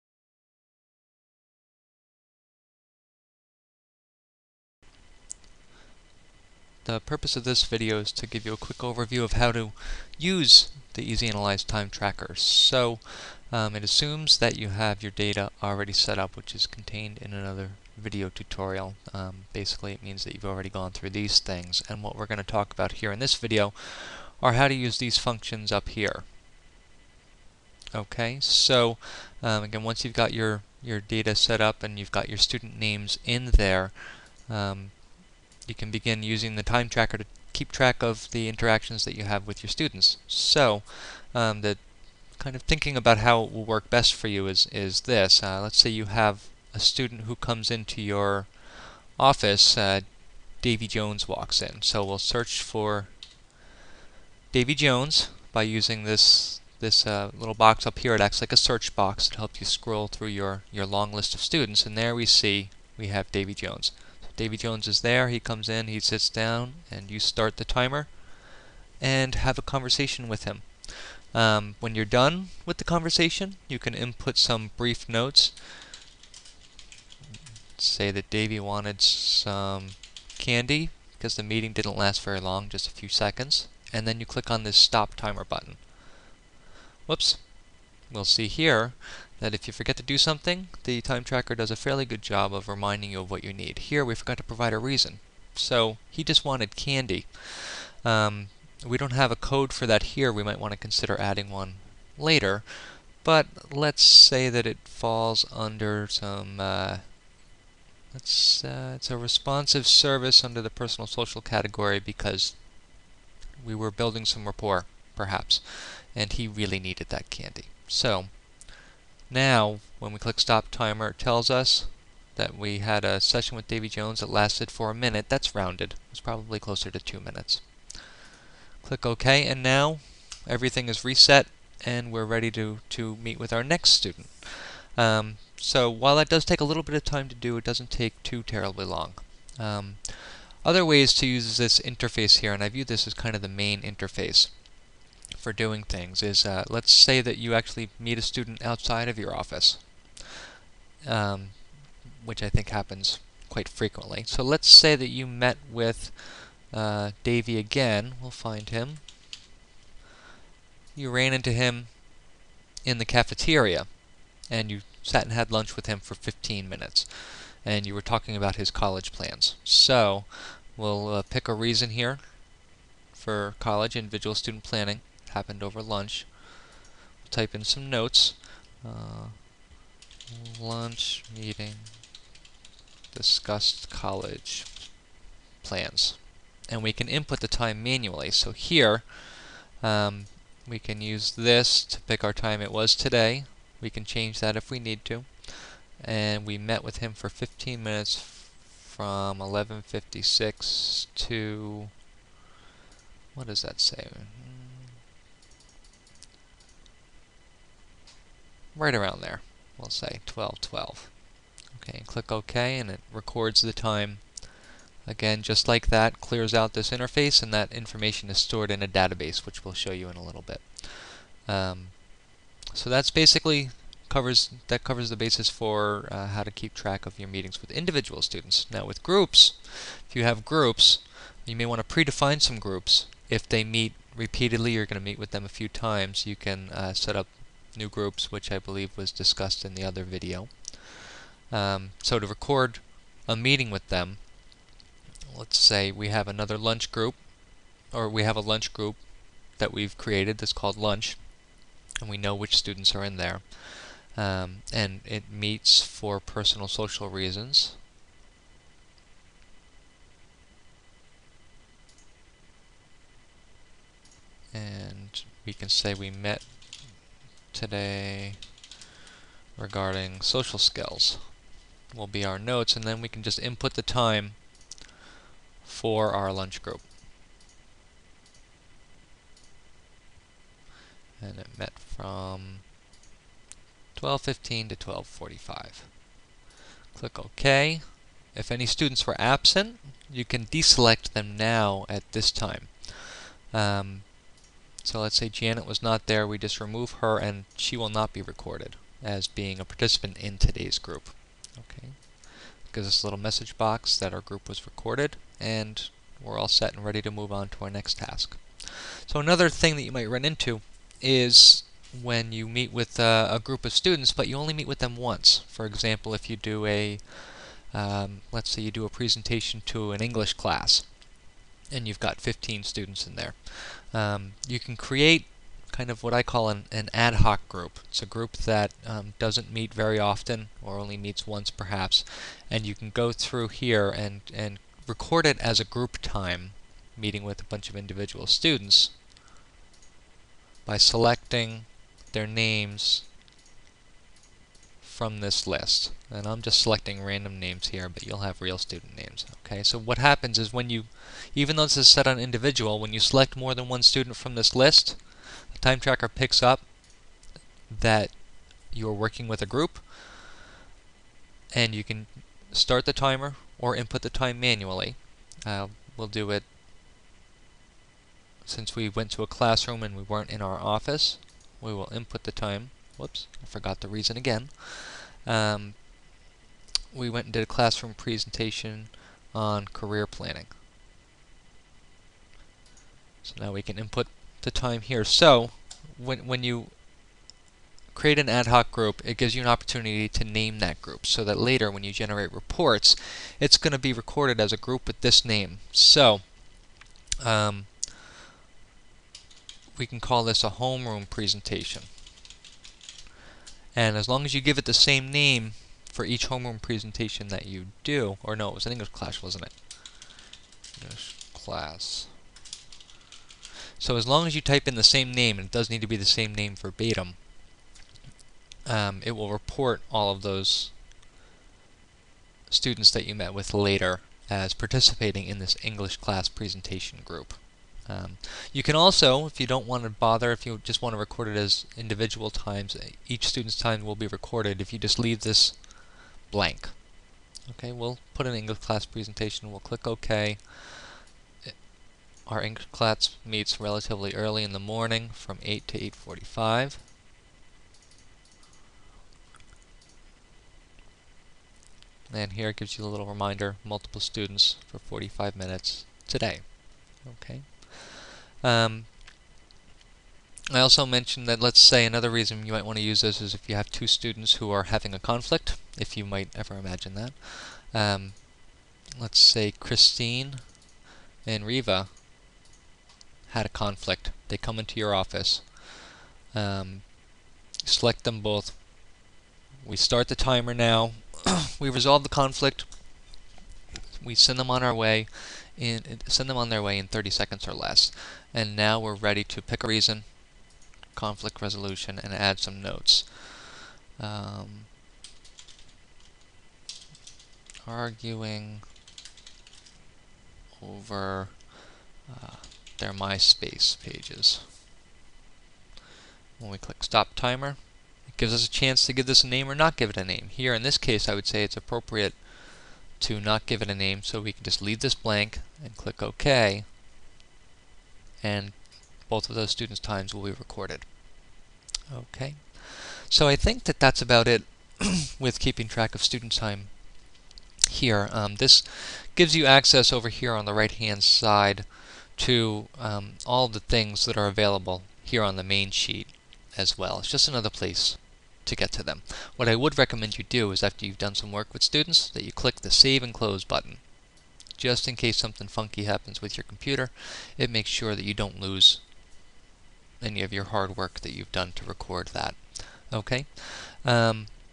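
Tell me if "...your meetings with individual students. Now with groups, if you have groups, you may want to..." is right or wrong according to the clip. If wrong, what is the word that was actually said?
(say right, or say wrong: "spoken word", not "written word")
right.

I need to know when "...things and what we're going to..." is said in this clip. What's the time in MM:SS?
00:21.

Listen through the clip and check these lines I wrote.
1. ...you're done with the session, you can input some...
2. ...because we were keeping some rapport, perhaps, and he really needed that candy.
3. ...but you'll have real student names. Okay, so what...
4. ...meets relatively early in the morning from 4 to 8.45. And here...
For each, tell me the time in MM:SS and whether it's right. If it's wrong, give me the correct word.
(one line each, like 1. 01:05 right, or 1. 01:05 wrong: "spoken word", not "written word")
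1. 01:11 wrong: "conversation", not "session"
2. 01:51 wrong: "building", not "keeping"
3. 05:47 right
4. 07:23 wrong: "8", not "4".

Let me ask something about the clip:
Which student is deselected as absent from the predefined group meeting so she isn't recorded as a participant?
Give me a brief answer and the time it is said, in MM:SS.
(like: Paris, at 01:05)
Janet, at 04:55.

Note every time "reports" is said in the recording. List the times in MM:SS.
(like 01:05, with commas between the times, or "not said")
06:32, 06:59.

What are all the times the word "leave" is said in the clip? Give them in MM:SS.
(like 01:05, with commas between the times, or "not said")
07:14, 08:34.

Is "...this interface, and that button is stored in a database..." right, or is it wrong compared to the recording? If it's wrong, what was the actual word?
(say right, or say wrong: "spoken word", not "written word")
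wrong: "information", not "button".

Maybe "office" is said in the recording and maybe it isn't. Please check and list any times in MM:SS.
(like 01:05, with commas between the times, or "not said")
00:49, 02:29, 06:10, 07:54.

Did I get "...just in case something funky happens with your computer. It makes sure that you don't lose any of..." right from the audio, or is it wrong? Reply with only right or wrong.
right.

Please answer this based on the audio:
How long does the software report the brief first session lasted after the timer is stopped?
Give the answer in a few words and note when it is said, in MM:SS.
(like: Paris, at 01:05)
a minute, at 02:04.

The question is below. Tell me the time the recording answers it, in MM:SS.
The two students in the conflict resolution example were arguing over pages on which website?
08:22.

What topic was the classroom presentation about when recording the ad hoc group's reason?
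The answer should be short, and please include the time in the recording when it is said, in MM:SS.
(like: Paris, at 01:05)
career planning, at 06:19.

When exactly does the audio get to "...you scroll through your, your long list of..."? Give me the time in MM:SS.
00:59.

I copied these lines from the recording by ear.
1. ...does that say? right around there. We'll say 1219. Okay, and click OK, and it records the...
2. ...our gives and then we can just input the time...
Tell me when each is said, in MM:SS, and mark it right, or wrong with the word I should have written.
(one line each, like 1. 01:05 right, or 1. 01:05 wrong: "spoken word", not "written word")
1. 03:23 wrong: "1212", not "1219"
2. 04:32 wrong: "notes", not "gives".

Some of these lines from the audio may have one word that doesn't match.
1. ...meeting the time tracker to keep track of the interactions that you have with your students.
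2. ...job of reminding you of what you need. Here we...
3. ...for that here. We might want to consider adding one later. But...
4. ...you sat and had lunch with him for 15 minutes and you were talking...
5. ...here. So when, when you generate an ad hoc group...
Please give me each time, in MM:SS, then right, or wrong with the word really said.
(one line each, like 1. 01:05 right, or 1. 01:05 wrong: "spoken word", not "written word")
1. 00:36 wrong: "using", not "meeting"
2. 01:32 right
3. 01:39 right
4. 02:44 right
5. 06:24 wrong: "create", not "generate".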